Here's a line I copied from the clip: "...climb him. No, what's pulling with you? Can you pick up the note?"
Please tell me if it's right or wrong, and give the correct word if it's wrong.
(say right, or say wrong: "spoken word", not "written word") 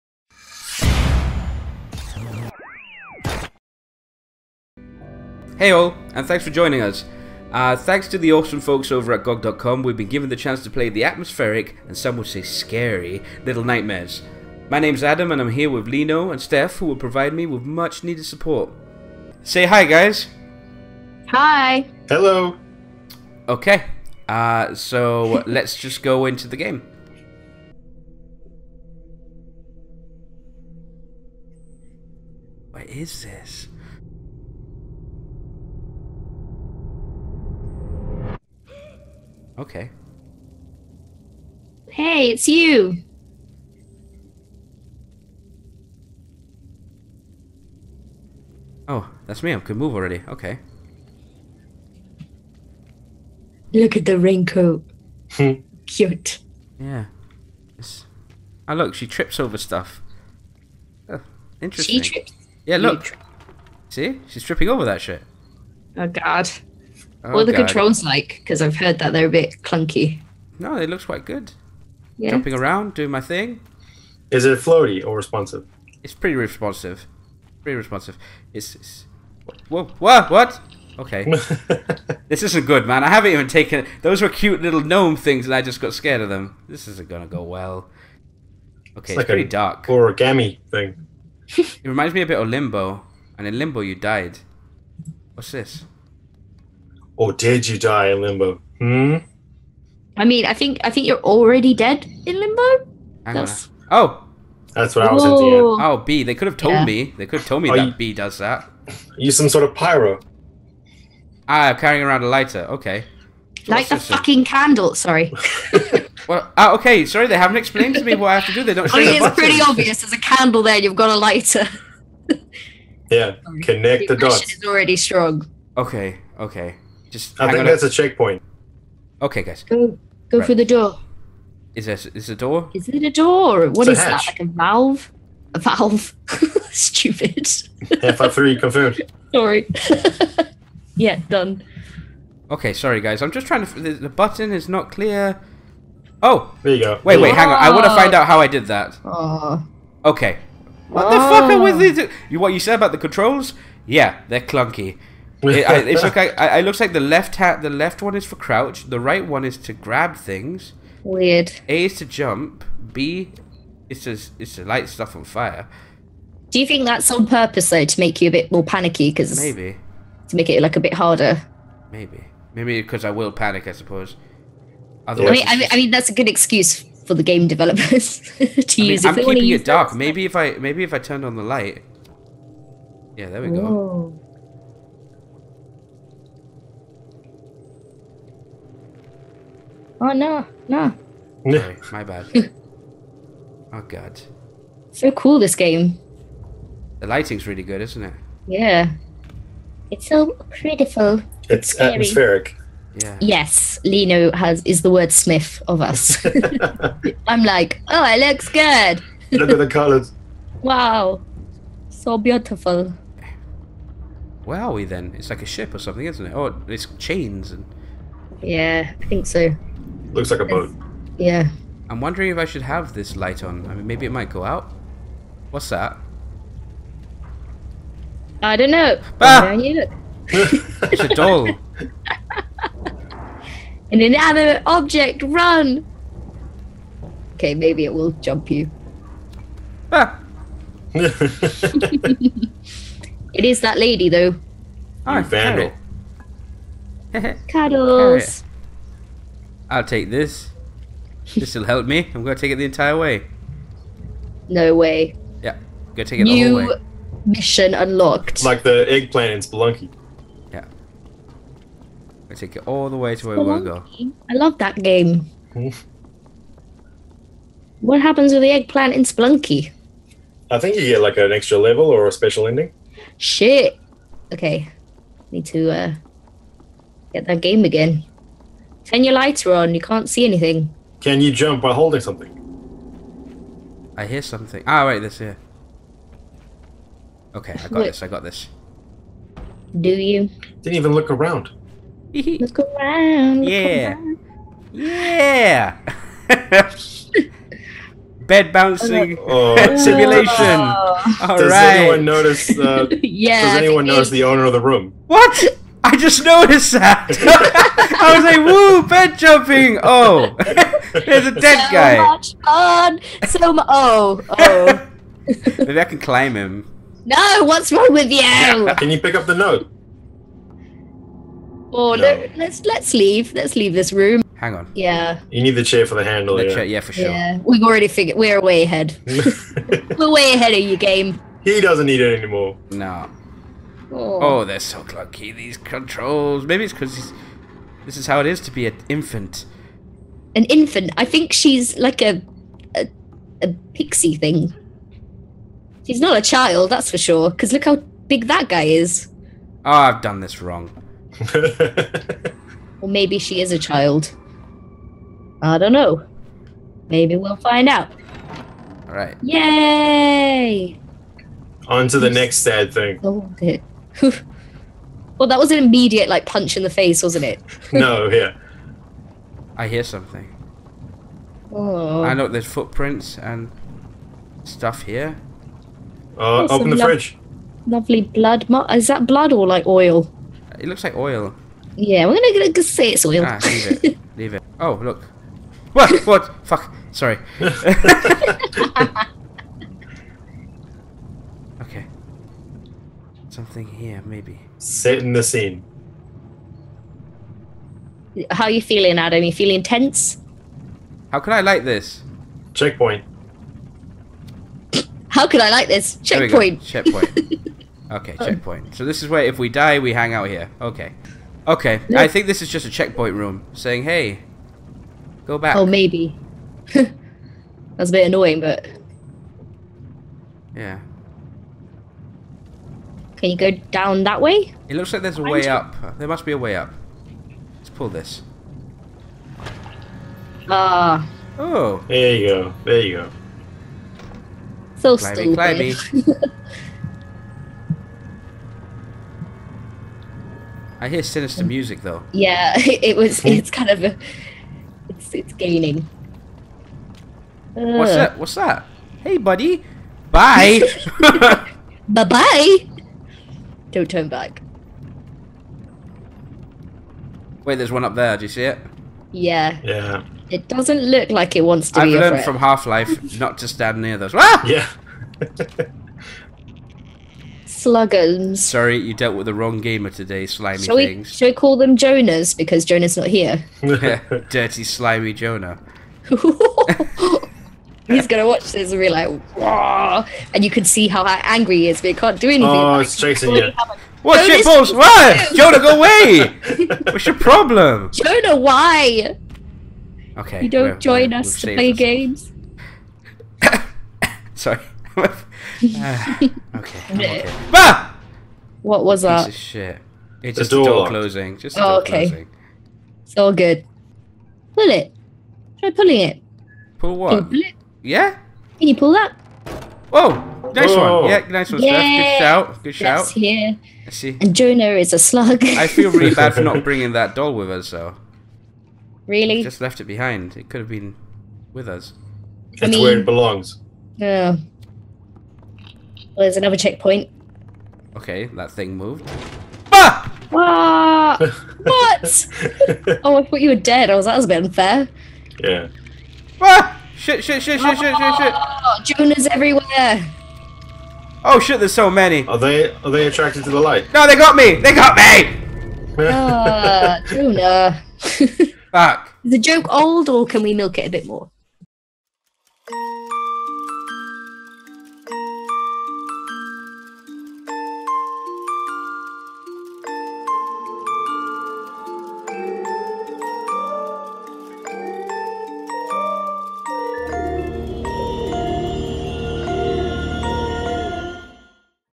wrong: "wrong", not "pulling".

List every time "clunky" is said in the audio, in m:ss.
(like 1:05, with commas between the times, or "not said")
1:09, 2:34, 5:34.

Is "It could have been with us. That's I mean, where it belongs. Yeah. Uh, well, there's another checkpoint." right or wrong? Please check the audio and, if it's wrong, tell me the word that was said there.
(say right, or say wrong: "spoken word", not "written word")
right.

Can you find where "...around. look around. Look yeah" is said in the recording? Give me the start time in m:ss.
4:51.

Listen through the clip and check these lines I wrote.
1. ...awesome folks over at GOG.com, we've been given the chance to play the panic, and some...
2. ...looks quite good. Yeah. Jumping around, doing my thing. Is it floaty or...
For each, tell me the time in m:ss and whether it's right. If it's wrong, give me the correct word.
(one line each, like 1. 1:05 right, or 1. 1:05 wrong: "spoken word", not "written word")
1. 0:08 wrong: "atmospheric", not "panic"
2. 1:10 right.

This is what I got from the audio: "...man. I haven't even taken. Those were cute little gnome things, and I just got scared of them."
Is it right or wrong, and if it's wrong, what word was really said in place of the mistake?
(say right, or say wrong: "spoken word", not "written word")
right.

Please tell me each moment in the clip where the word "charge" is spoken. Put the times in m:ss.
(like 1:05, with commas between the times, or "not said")
not said.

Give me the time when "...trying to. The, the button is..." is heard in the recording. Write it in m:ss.
2:23.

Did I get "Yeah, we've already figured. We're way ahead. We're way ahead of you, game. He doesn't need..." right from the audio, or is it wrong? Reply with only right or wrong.
right.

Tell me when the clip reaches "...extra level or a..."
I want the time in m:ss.
4:31.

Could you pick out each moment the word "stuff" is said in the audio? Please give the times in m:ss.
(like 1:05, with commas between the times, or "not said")
0:59, 2:44, 6:14.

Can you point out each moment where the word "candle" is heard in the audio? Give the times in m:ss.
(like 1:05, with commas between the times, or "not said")
1:54, 2:00.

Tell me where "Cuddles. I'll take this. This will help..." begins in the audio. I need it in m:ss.
4:07.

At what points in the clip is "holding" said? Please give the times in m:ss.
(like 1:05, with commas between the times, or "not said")
4:41.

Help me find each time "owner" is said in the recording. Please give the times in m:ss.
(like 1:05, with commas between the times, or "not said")
5:04.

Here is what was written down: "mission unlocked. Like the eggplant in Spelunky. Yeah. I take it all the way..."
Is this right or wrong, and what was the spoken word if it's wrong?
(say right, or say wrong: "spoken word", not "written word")
right.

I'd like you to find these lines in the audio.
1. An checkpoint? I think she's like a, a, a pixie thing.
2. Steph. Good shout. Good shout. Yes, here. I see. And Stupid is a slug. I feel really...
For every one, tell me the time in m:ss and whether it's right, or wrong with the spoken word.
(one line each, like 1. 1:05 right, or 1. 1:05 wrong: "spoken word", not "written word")
1. 5:40 wrong: "infant", not "checkpoint"
2. 8:32 wrong: "Jonah", not "Stupid".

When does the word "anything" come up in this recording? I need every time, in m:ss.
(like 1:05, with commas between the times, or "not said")
4:40, 8:02.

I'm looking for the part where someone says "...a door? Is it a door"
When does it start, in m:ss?
2:12.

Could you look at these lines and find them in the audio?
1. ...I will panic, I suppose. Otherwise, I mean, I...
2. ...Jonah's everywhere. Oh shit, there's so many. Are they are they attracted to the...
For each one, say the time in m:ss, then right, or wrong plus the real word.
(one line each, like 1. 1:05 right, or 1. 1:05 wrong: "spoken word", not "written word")
1. 2:53 right
2. 8:58 right.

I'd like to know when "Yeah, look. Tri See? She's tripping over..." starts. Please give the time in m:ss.
1:02.